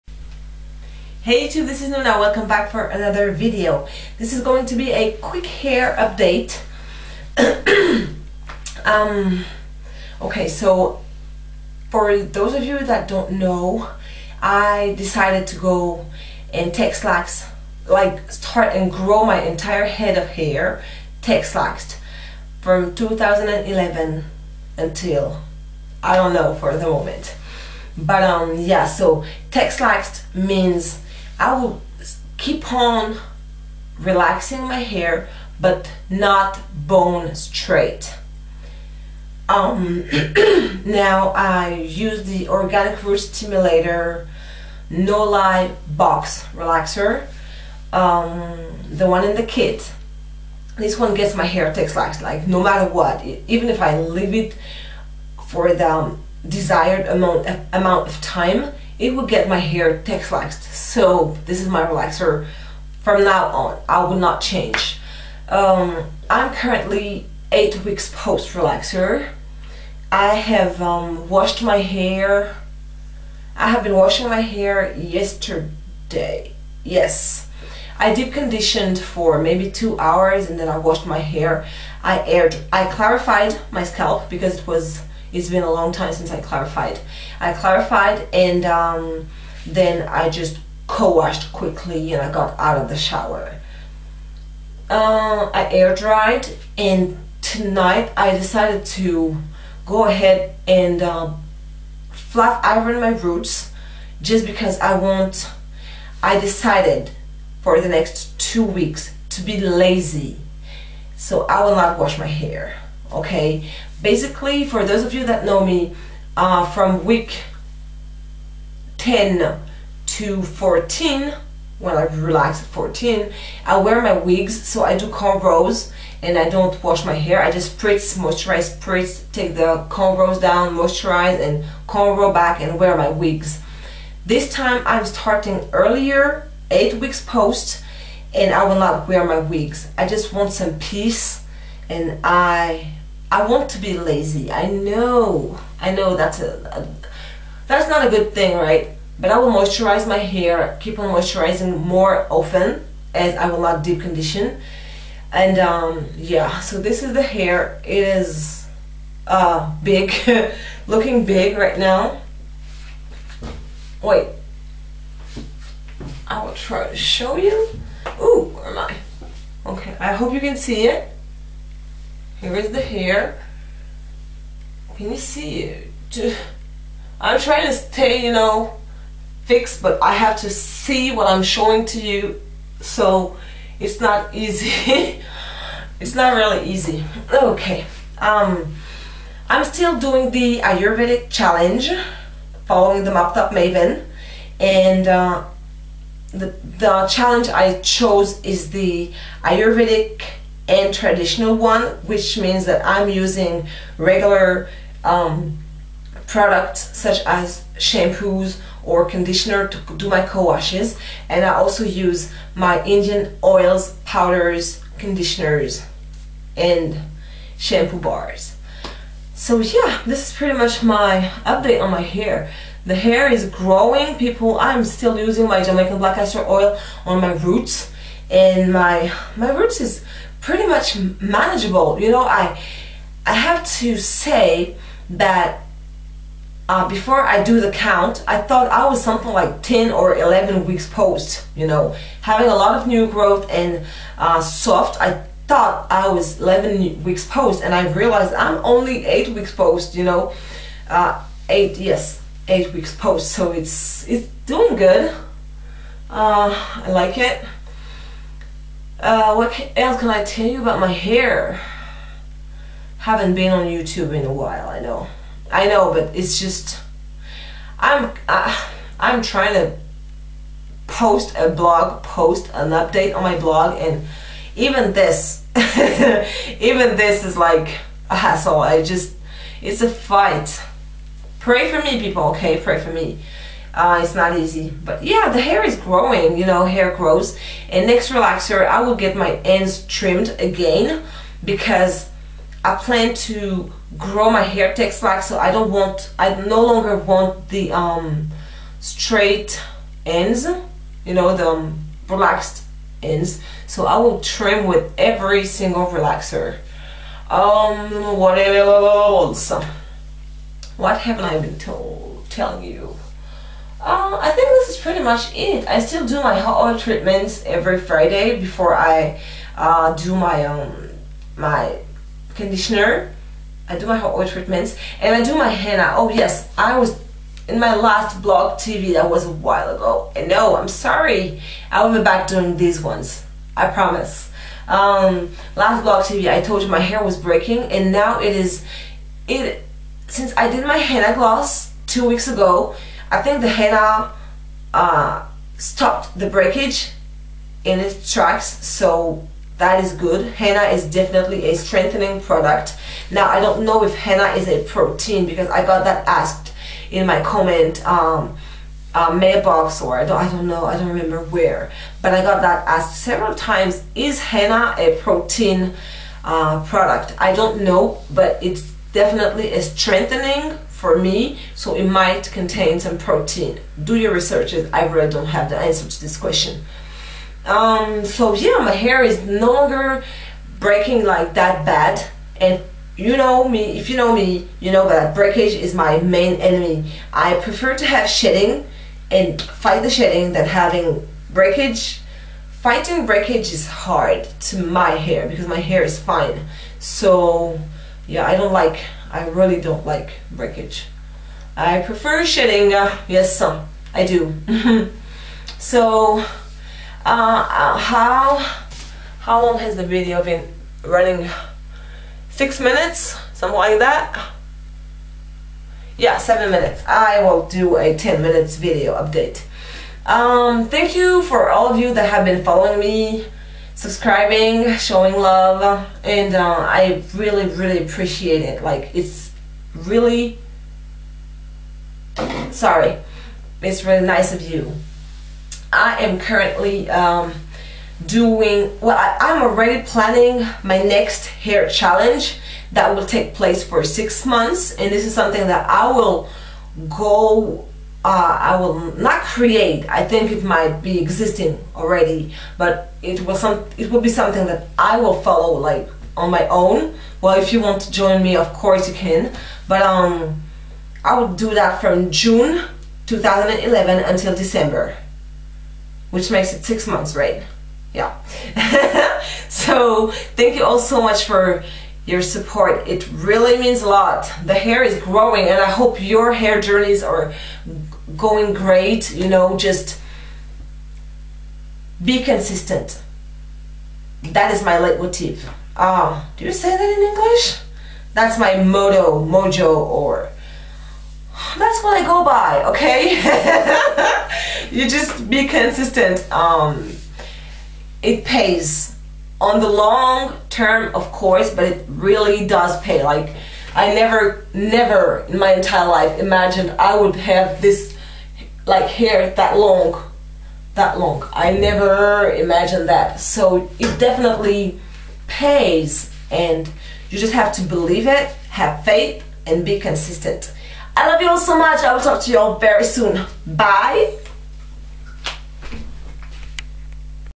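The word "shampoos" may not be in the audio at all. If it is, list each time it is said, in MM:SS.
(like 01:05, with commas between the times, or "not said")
03:27, 03:37.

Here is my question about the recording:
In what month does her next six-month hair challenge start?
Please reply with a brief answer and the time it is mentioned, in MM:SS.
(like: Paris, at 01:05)
June, at 07:42.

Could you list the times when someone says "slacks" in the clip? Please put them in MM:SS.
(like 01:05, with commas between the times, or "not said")
00:17, 00:21, 00:29.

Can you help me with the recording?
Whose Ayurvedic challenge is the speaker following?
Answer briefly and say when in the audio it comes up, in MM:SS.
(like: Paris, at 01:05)
Moptop Maven, at 03:13.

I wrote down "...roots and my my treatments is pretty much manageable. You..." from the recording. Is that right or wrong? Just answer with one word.
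wrong.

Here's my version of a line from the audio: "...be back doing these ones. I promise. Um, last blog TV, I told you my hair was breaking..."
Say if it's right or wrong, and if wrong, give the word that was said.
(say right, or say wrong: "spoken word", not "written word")
right.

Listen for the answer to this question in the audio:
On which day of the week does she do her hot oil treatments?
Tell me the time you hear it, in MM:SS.
05:17.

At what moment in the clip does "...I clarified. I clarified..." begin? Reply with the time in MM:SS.
01:26.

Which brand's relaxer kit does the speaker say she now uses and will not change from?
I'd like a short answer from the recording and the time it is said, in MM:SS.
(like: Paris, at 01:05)
Organic Root Stimulator, at 00:42.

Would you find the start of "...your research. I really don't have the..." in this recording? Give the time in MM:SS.
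06:13.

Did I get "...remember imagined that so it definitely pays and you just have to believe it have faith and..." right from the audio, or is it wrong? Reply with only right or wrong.
wrong.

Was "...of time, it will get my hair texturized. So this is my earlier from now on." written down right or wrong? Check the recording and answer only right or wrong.
wrong.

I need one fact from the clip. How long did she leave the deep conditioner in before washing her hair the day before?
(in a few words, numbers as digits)
2 hours.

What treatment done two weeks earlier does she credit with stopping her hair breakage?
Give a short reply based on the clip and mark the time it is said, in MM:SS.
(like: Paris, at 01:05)
henna gloss, at 05:40.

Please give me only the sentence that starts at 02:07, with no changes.
I just spritz, moisturize, spritz, take the cornrows down, moisturize and cornrow back and wear my wigs.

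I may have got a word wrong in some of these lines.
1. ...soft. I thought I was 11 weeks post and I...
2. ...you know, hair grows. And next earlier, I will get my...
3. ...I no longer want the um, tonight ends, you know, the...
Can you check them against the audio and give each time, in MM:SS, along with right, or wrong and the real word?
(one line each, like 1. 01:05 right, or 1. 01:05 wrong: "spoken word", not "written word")
1. 04:04 right
2. 04:46 wrong: "relaxer", not "earlier"
3. 04:56 wrong: "straight", not "tonight".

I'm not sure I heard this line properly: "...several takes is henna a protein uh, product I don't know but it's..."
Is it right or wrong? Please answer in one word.
wrong.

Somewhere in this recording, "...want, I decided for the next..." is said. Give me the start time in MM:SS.
01:44.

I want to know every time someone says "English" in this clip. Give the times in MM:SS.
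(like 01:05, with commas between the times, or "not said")
08:07.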